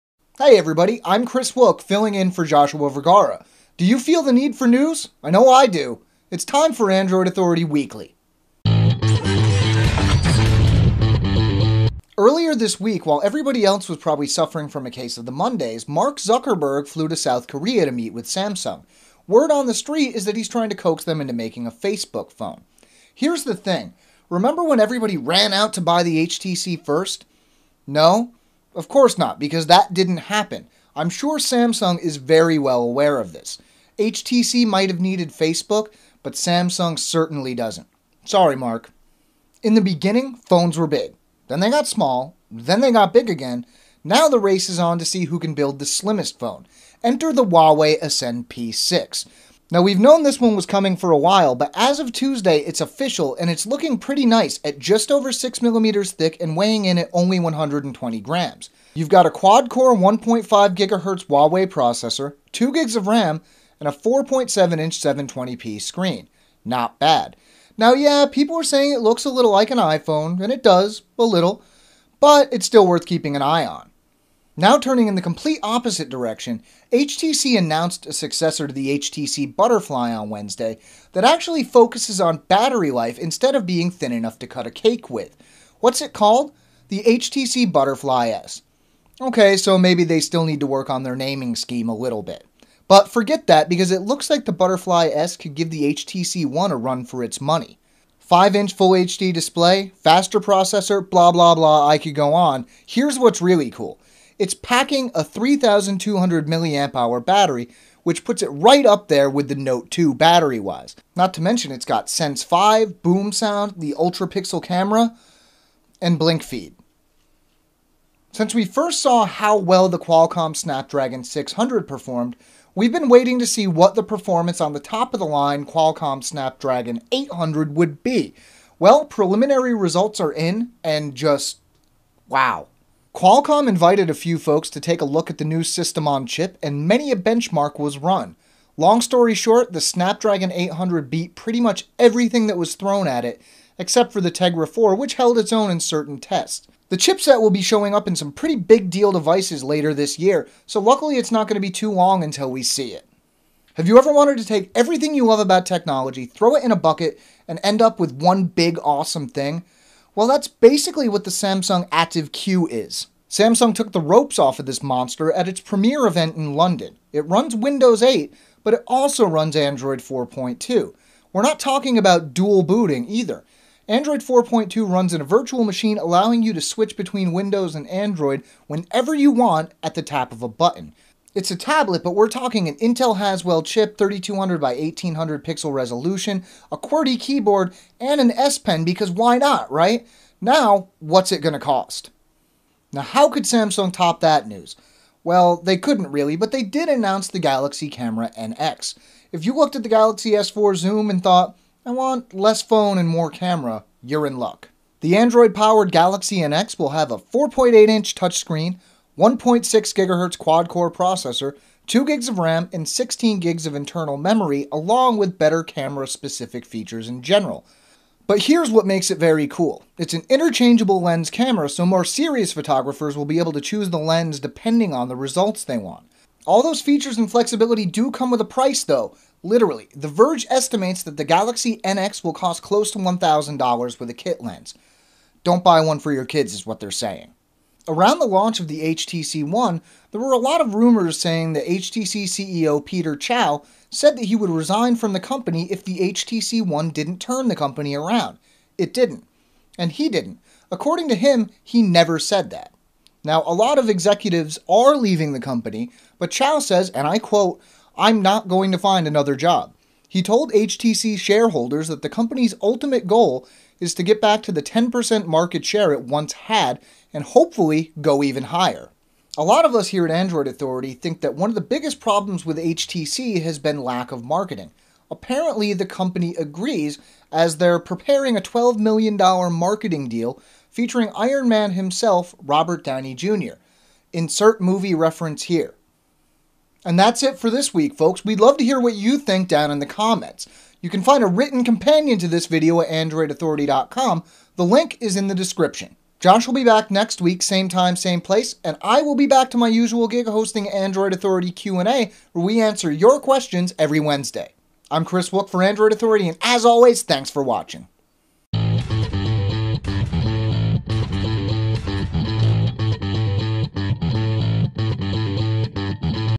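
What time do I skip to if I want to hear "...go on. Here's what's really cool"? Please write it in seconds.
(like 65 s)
102 s.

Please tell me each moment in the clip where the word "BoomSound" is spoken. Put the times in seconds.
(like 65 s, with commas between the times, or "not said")
113 s.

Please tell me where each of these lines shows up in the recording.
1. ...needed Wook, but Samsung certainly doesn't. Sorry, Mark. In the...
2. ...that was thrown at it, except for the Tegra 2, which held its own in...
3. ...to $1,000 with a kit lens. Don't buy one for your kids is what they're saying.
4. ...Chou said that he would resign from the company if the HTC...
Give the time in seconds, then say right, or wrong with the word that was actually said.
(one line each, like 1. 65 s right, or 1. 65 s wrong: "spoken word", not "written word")
1. 34 s wrong: "Facebook", not "Wook"
2. 142 s wrong: "4", not "2"
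3. 232 s right
4. 243 s right.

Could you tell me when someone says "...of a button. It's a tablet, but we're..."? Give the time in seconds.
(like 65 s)
180 s.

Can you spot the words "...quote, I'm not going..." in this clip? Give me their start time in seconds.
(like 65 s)
257 s.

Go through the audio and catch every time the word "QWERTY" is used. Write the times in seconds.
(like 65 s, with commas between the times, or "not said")
186 s.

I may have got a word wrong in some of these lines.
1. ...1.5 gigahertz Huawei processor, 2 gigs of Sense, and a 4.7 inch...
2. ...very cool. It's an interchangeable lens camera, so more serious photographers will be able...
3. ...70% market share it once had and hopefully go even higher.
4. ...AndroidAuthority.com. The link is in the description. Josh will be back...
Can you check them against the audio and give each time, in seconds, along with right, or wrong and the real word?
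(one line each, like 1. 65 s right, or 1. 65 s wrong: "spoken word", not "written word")
1. 59 s wrong: "RAM", not "Sense"
2. 219 s right
3. 264 s wrong: "10", not "70"
4. 292 s right.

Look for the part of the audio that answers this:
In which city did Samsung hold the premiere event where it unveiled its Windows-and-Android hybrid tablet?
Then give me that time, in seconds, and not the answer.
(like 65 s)
166 s.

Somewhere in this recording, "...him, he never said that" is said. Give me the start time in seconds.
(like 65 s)
251 s.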